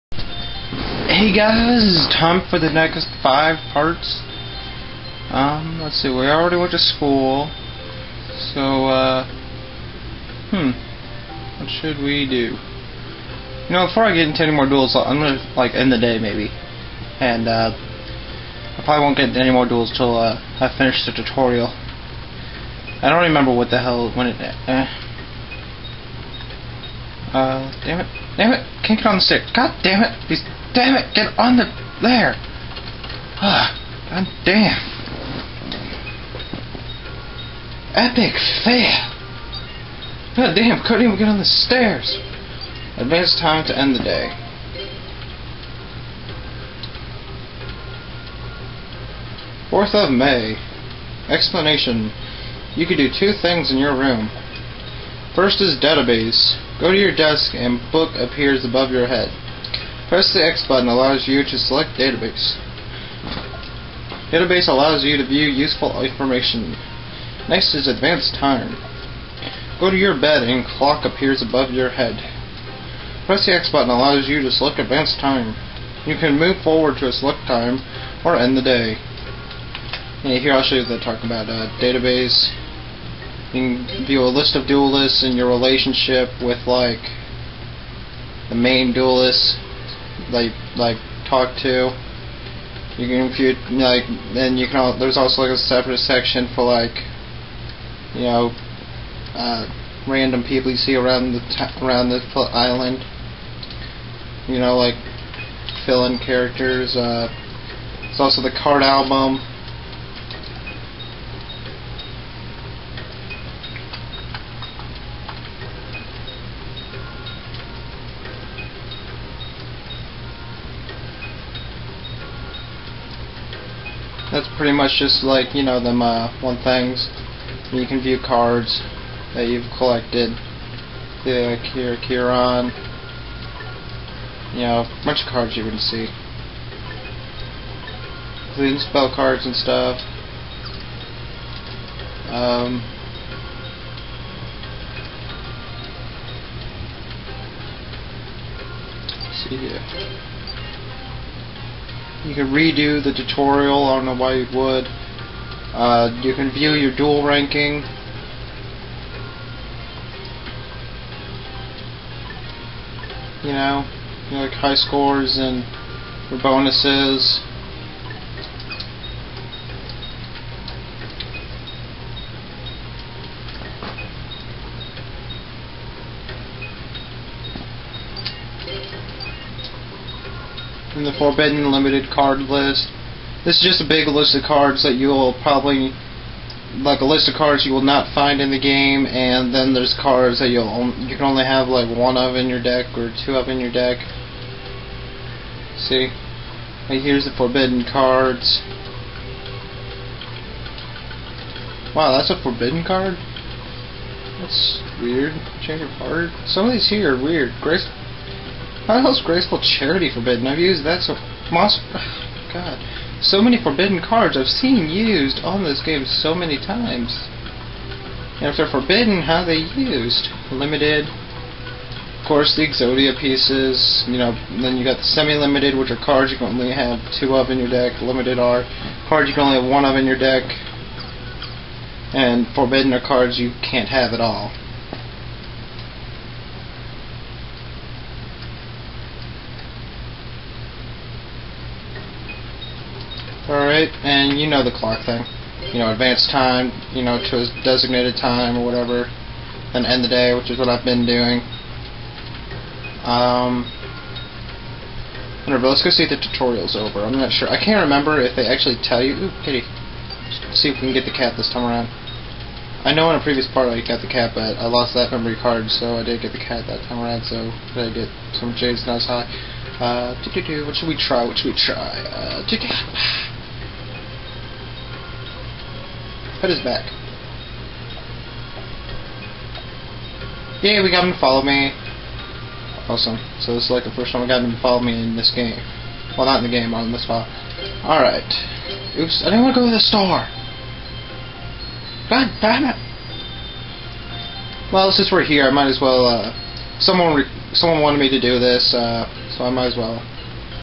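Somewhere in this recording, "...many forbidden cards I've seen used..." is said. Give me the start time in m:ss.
3:33.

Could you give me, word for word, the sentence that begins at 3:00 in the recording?
in the Forbidden Limited card list.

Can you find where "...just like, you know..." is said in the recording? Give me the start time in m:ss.
2:04.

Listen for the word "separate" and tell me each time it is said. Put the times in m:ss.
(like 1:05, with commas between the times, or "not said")
1:35.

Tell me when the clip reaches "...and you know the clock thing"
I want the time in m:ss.
4:04.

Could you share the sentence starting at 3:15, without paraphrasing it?
See, right here's the forbidden cards.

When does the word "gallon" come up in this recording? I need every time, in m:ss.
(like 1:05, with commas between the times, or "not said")
not said.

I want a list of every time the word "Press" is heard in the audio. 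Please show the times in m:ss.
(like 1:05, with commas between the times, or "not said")
1:00, 1:13.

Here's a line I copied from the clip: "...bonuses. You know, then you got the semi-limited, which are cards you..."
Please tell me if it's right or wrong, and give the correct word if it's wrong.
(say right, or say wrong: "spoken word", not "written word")
wrong: "pieces", not "bonuses".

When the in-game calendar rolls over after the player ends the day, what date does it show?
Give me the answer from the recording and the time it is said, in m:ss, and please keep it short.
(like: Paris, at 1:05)
4th of May, at 0:49.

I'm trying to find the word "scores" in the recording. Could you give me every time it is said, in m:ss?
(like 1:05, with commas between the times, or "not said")
2:44.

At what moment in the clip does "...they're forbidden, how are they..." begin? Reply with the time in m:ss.
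3:38.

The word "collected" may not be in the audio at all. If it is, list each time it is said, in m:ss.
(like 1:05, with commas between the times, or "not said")
2:09.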